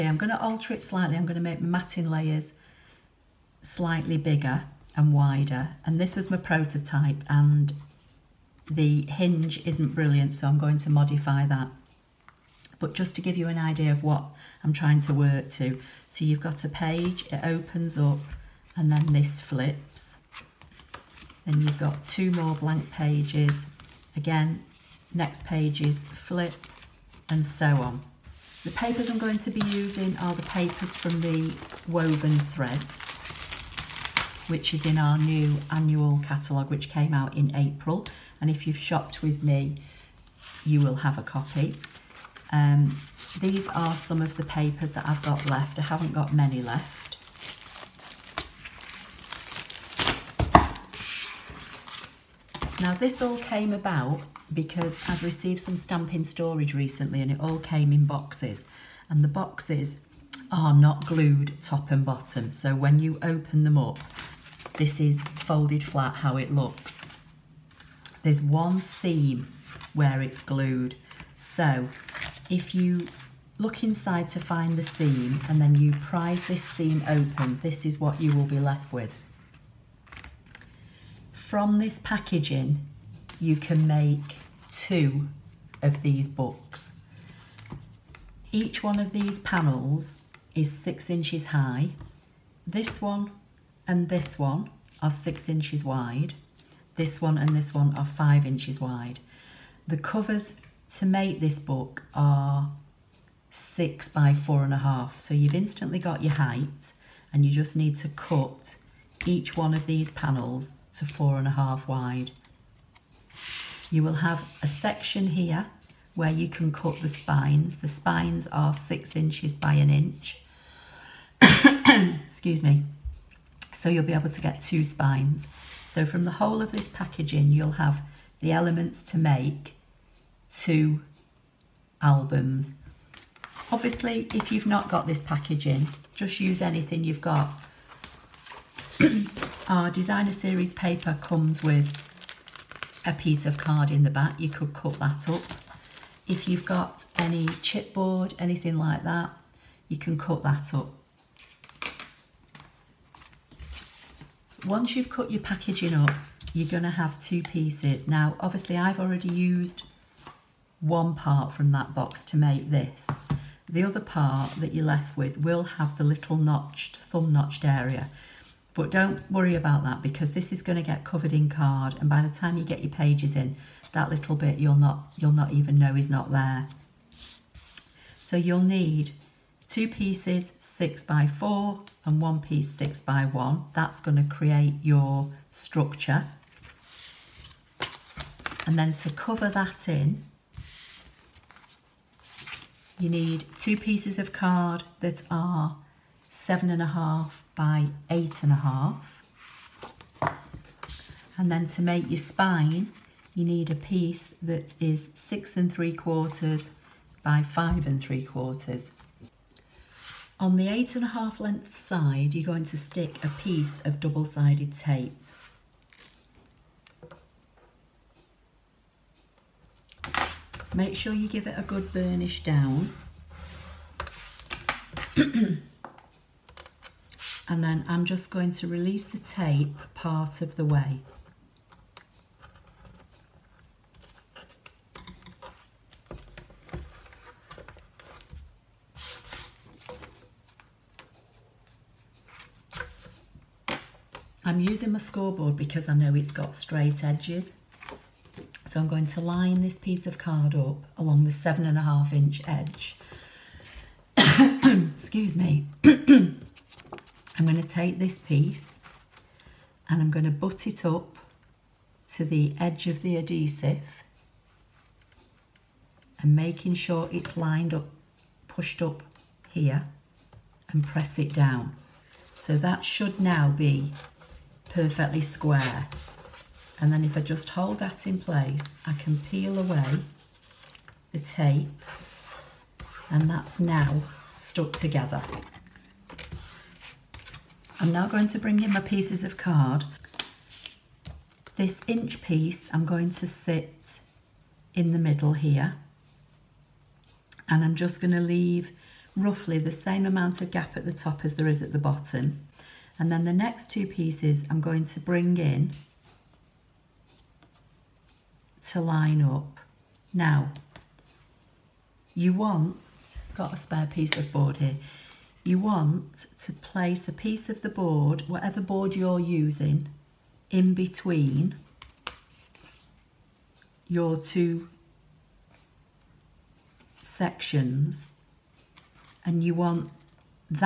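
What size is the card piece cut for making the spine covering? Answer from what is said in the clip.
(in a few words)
6.75 by 5.75 inches.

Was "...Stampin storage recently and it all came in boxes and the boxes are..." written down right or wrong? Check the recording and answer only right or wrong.
right.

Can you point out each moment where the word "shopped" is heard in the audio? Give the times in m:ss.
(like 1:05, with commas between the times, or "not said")
0:38.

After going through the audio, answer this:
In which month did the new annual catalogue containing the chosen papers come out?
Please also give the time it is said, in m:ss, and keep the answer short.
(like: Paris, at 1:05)
April, at 0:37.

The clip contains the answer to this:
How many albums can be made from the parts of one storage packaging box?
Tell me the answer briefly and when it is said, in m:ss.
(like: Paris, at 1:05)
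2, at 2:10.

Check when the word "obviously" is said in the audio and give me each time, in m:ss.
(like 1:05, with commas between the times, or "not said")
2:13, 2:38.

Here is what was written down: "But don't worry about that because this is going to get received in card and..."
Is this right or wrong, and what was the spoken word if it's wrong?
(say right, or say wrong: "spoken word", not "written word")
wrong: "covered", not "received".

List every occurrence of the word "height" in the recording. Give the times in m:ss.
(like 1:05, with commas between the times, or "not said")
1:46.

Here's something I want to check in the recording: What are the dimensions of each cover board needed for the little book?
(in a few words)
6 by 4.5 inches.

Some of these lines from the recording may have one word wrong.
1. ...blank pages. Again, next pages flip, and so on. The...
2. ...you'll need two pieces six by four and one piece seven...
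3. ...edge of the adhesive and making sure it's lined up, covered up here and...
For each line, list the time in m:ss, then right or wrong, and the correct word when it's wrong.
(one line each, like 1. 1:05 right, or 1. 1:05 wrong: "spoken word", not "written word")
1. 0:22 right
2. 2:58 wrong: "six", not "seven"
3. 4:22 wrong: "pushed", not "covered".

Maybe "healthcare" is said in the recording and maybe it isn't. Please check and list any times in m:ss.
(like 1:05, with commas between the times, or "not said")
not said.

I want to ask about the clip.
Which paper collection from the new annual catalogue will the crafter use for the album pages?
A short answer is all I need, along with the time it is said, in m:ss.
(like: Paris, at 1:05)
Woven Threads, at 0:31.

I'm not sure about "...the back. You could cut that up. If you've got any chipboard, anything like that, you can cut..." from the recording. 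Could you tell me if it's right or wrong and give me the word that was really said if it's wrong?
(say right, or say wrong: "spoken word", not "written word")
right.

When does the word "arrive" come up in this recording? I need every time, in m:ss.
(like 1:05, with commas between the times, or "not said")
not said.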